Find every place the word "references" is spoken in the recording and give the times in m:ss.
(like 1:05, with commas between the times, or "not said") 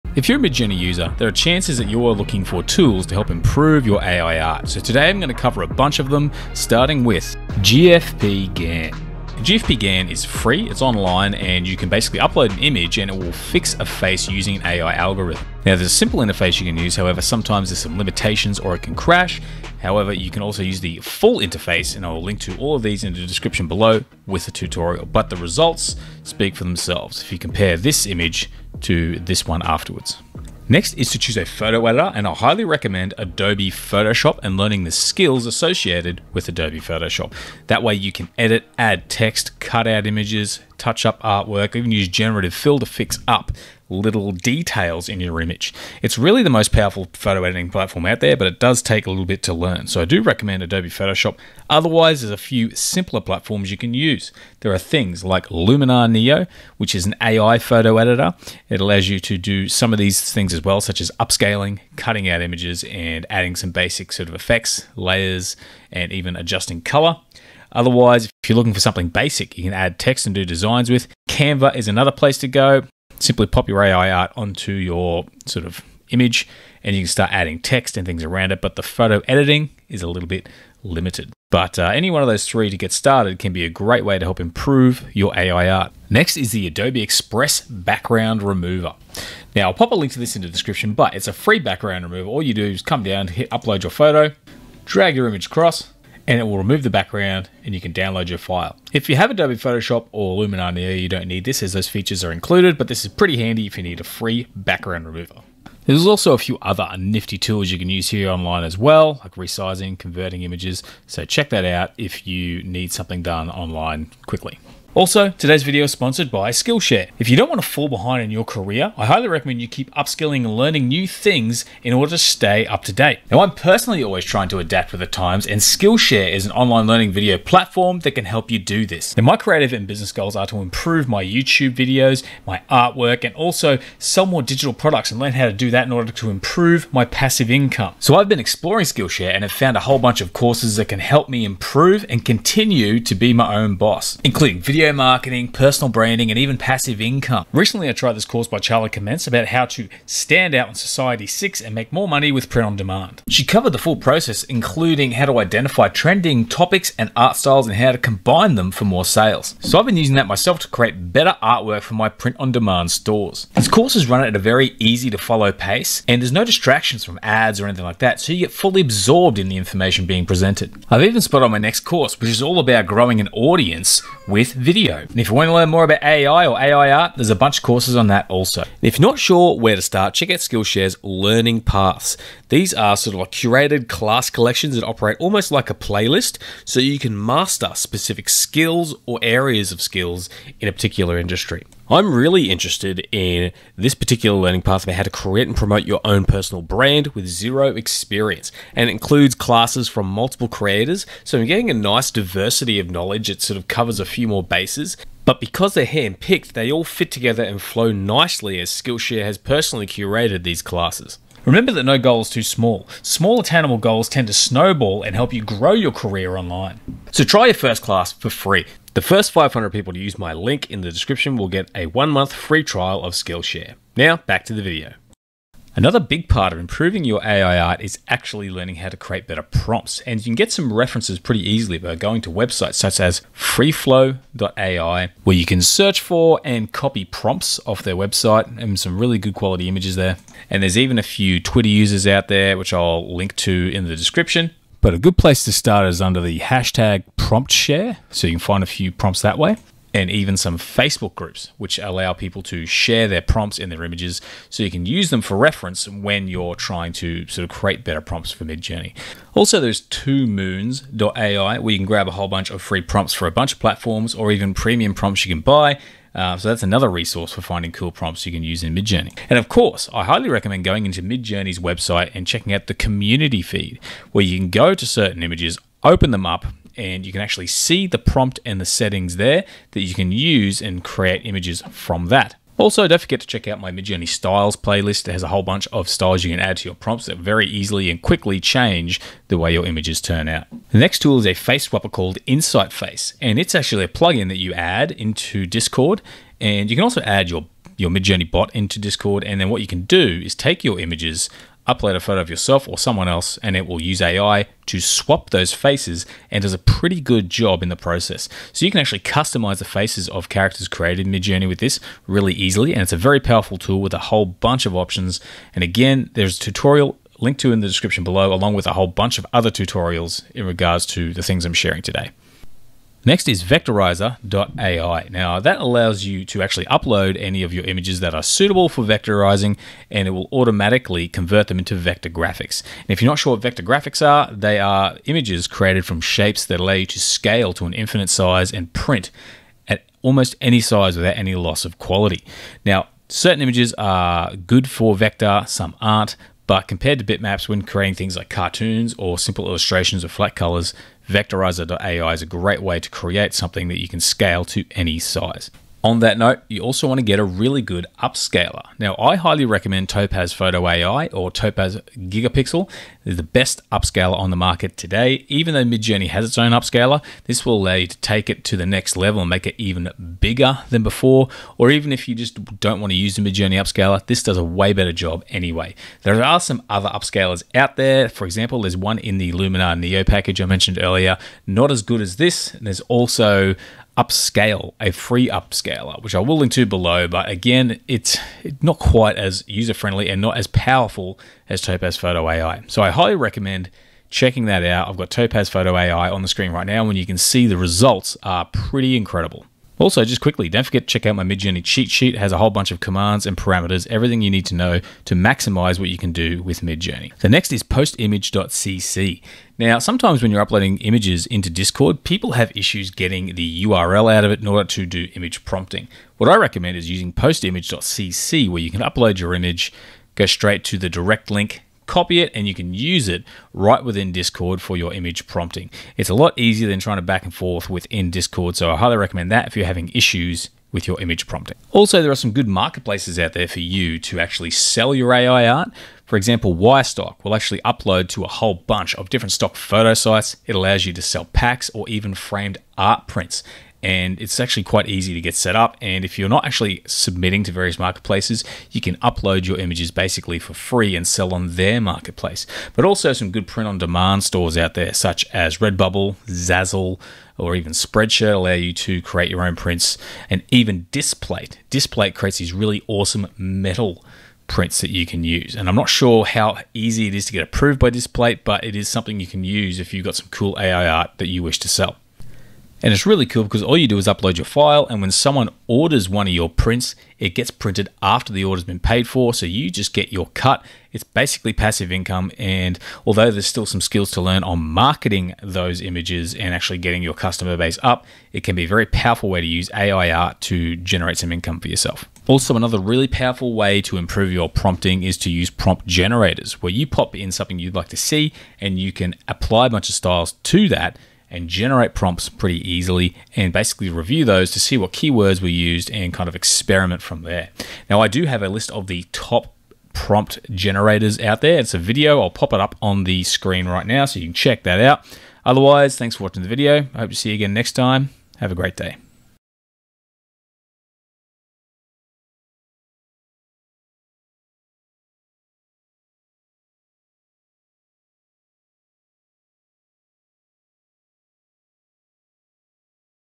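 3:50, 4:15.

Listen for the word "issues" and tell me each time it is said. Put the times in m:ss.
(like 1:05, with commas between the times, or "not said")
6:52, 7:09.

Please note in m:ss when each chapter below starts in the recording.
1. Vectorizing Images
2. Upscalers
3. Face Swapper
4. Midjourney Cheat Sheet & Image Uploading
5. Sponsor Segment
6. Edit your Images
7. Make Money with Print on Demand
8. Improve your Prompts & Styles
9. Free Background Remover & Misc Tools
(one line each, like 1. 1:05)
1. 5:20
2. 5:54
3. 4:49
4. 6:38
5. 1:53
6. 0:30
7. 7:10
8. 3:44
9. 1:24.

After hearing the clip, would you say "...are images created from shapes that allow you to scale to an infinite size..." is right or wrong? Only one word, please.
right.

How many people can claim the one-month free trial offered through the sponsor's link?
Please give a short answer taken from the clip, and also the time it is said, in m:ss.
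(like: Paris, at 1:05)
500, at 3:39.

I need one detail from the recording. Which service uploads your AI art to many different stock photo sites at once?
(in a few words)
Wirestock.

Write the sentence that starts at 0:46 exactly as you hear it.
It's really the most powerful photo editing platform out there, but it does take a little bit to learn.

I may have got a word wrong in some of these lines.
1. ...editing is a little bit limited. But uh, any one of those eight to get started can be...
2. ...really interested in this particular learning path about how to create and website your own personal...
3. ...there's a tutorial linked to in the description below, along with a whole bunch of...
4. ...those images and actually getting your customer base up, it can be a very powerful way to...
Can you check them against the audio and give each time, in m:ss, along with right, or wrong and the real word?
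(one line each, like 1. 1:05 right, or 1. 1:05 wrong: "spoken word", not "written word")
1. 1:19 wrong: "three", not "eight"
2. 3:12 wrong: "promote", not "website"
3. 5:16 right
4. 8:05 right.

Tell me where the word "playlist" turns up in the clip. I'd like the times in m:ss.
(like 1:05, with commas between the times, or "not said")
3:05, 4:44.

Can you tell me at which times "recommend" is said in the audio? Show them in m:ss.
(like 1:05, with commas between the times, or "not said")
0:32, 0:50, 1:59, 4:30, 5:59, 6:33, 6:56, 7:08.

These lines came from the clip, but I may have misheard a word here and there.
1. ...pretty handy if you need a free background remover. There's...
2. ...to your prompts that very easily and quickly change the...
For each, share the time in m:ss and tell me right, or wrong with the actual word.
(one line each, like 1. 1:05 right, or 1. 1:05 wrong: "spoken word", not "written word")
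1. 1:43 right
2. 4:46 right.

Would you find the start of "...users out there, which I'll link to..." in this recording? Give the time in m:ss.
4:01.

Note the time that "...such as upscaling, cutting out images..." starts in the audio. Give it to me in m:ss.
1:00.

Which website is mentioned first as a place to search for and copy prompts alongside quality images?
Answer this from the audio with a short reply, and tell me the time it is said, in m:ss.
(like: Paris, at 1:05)
freeflow.ai, at 3:53.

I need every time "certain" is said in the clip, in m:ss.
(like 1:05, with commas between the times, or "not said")
4:34, 5:43.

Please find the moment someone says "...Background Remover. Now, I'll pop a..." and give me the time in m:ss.
1:27.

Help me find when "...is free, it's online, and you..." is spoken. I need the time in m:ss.
0:10.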